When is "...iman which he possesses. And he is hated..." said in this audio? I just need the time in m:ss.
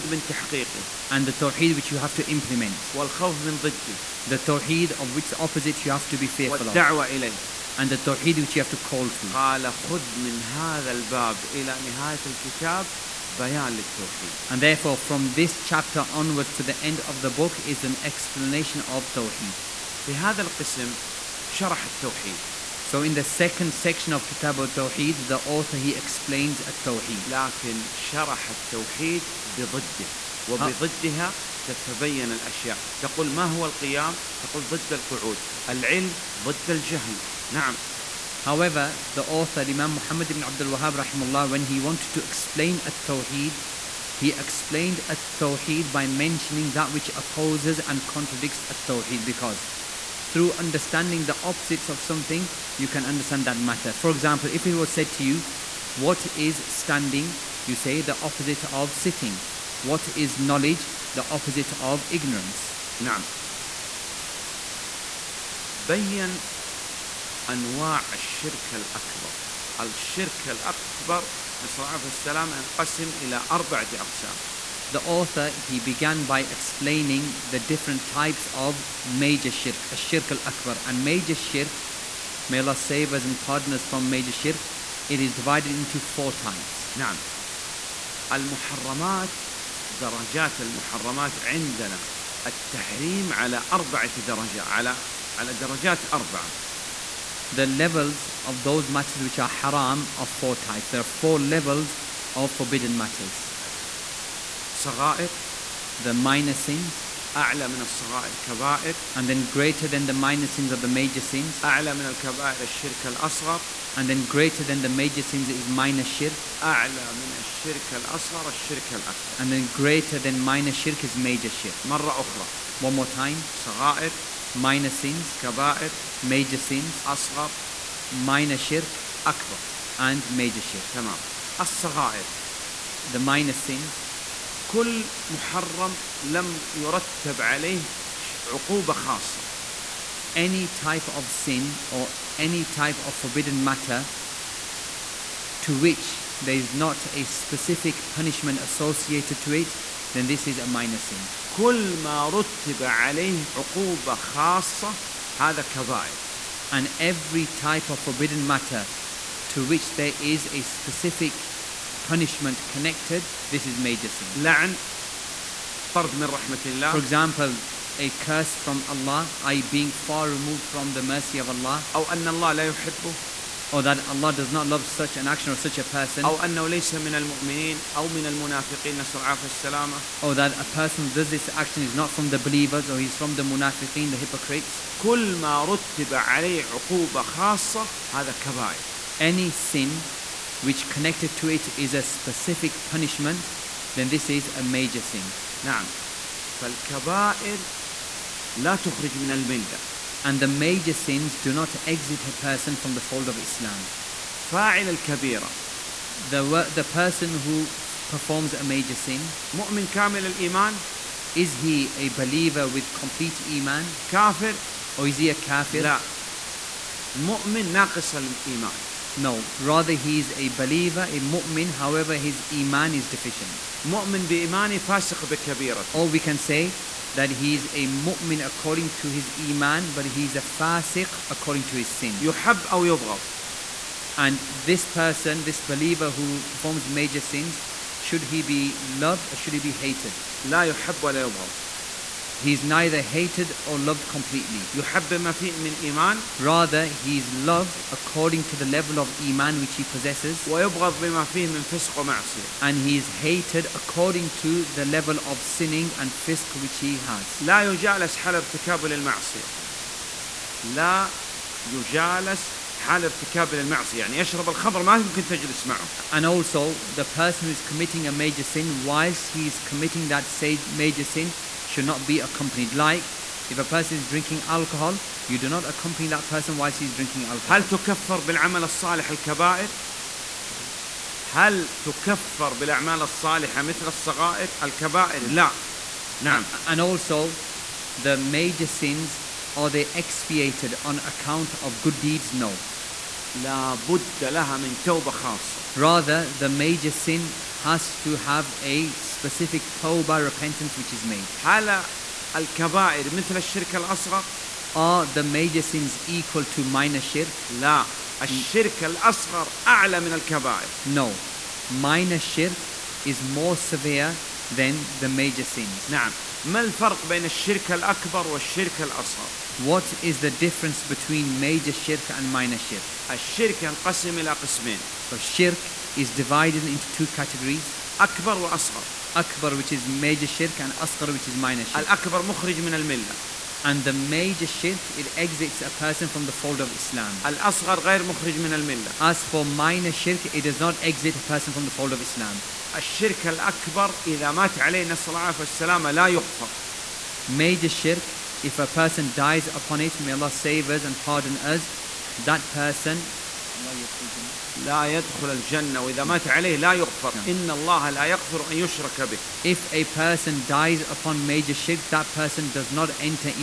4:09.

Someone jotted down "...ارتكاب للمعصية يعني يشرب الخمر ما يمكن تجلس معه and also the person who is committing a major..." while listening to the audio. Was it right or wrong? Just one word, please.
right.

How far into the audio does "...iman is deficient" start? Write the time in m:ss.
3:42.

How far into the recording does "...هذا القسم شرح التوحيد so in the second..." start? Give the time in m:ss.
0:20.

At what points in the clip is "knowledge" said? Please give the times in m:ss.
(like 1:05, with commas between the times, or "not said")
1:00.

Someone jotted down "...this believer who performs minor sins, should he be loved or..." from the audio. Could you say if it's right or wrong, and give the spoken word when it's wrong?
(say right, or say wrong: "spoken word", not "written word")
wrong: "major", not "minor".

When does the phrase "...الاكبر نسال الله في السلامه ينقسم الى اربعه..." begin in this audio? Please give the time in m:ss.
1:10.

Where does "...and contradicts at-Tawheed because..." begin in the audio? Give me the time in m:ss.
0:47.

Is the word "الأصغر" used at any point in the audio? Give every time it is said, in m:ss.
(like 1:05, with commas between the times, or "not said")
1:53, 1:57, 5:03, 5:08, 5:18, 5:37.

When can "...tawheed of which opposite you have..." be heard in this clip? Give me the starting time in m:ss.
0:04.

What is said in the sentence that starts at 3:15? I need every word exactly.
نعم فالكبائر لا تخرج من الملة.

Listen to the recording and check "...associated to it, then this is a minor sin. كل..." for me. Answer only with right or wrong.
right.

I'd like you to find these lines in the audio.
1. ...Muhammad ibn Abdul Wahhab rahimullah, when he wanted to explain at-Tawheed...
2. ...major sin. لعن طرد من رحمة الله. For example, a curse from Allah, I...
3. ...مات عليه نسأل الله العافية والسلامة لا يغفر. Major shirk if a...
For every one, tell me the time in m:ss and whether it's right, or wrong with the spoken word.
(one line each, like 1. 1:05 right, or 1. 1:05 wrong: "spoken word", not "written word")
1. 0:39 right
2. 2:43 right
3. 5:44 right.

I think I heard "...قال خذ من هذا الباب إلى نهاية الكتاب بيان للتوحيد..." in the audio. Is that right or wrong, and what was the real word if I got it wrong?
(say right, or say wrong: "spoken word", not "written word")
right.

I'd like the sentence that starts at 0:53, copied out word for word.
For example, if it was said to you, What is standing?